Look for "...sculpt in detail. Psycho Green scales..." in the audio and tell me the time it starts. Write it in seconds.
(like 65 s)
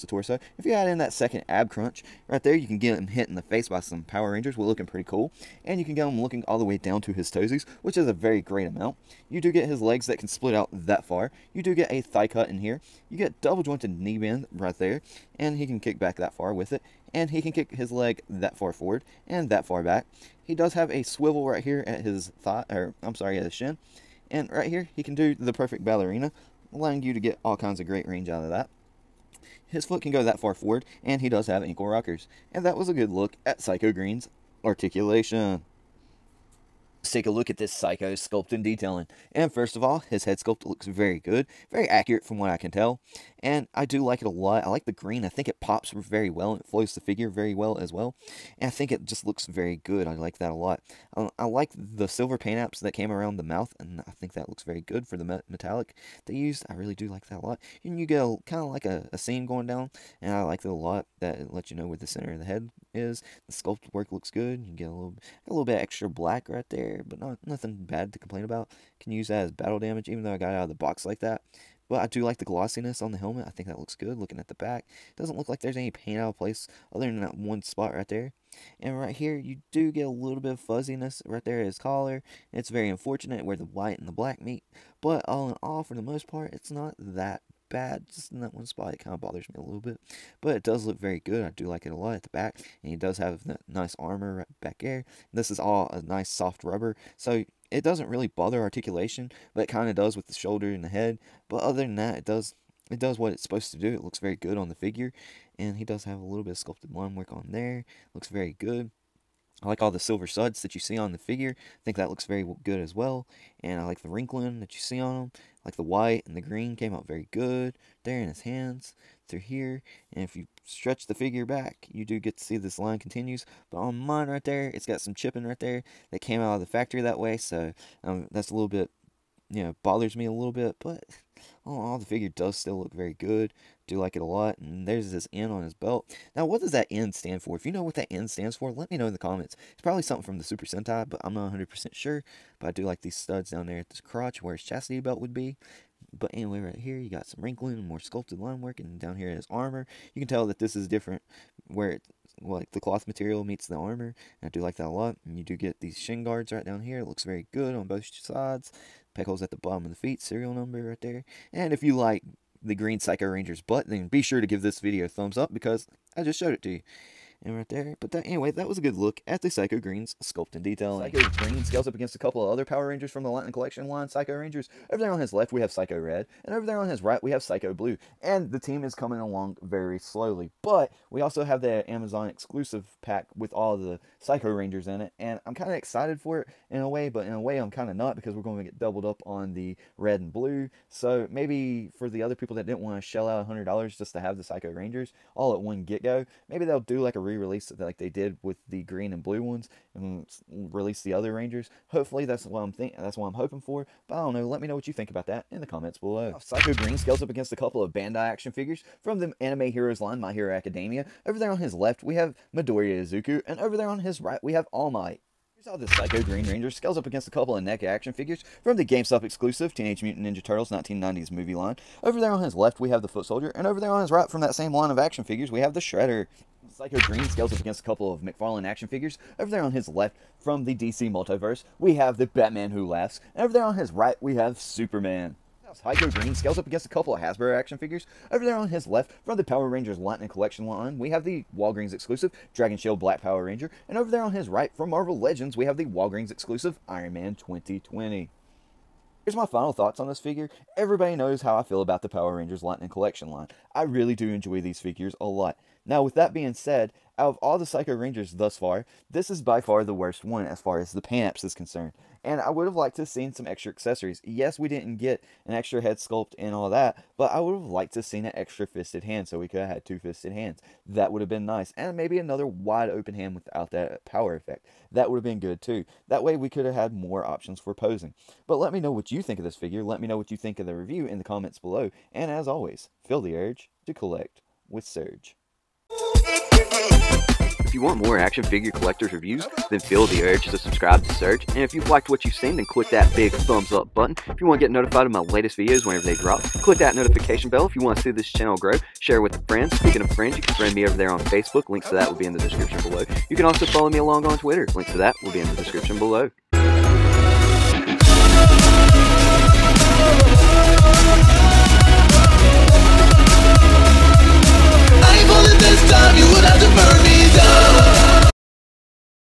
170 s.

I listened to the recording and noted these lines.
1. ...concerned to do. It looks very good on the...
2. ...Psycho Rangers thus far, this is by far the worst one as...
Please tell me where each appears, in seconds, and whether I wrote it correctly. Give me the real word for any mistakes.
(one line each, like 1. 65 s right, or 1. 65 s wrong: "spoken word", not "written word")
1. 103 s wrong: "supposed", not "concerned"
2. 257 s right.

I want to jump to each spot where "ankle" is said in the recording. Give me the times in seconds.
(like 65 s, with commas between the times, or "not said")
31 s.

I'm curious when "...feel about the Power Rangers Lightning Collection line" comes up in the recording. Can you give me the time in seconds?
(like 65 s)
251 s.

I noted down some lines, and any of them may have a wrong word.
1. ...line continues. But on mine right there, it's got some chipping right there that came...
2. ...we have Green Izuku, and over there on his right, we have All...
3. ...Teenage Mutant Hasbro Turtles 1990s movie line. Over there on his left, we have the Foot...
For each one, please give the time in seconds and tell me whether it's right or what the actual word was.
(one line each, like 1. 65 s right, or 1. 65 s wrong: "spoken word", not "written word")
1. 122 s right
2. 212 s wrong: "Midoriya", not "Green"
3. 219 s wrong: "Ninja", not "Hasbro".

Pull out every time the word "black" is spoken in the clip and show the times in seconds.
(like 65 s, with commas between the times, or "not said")
66 s, 84 s, 242 s.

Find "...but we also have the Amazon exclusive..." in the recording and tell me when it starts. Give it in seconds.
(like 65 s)
180 s.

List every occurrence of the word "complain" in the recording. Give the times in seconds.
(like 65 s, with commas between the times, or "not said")
68 s.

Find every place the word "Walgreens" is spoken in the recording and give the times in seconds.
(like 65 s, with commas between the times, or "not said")
241 s, 245 s.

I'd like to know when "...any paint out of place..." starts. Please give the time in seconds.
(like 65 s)
75 s.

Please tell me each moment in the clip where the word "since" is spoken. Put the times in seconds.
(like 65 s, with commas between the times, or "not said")
not said.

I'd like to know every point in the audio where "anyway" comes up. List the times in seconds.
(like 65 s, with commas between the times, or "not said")
146 s, 168 s.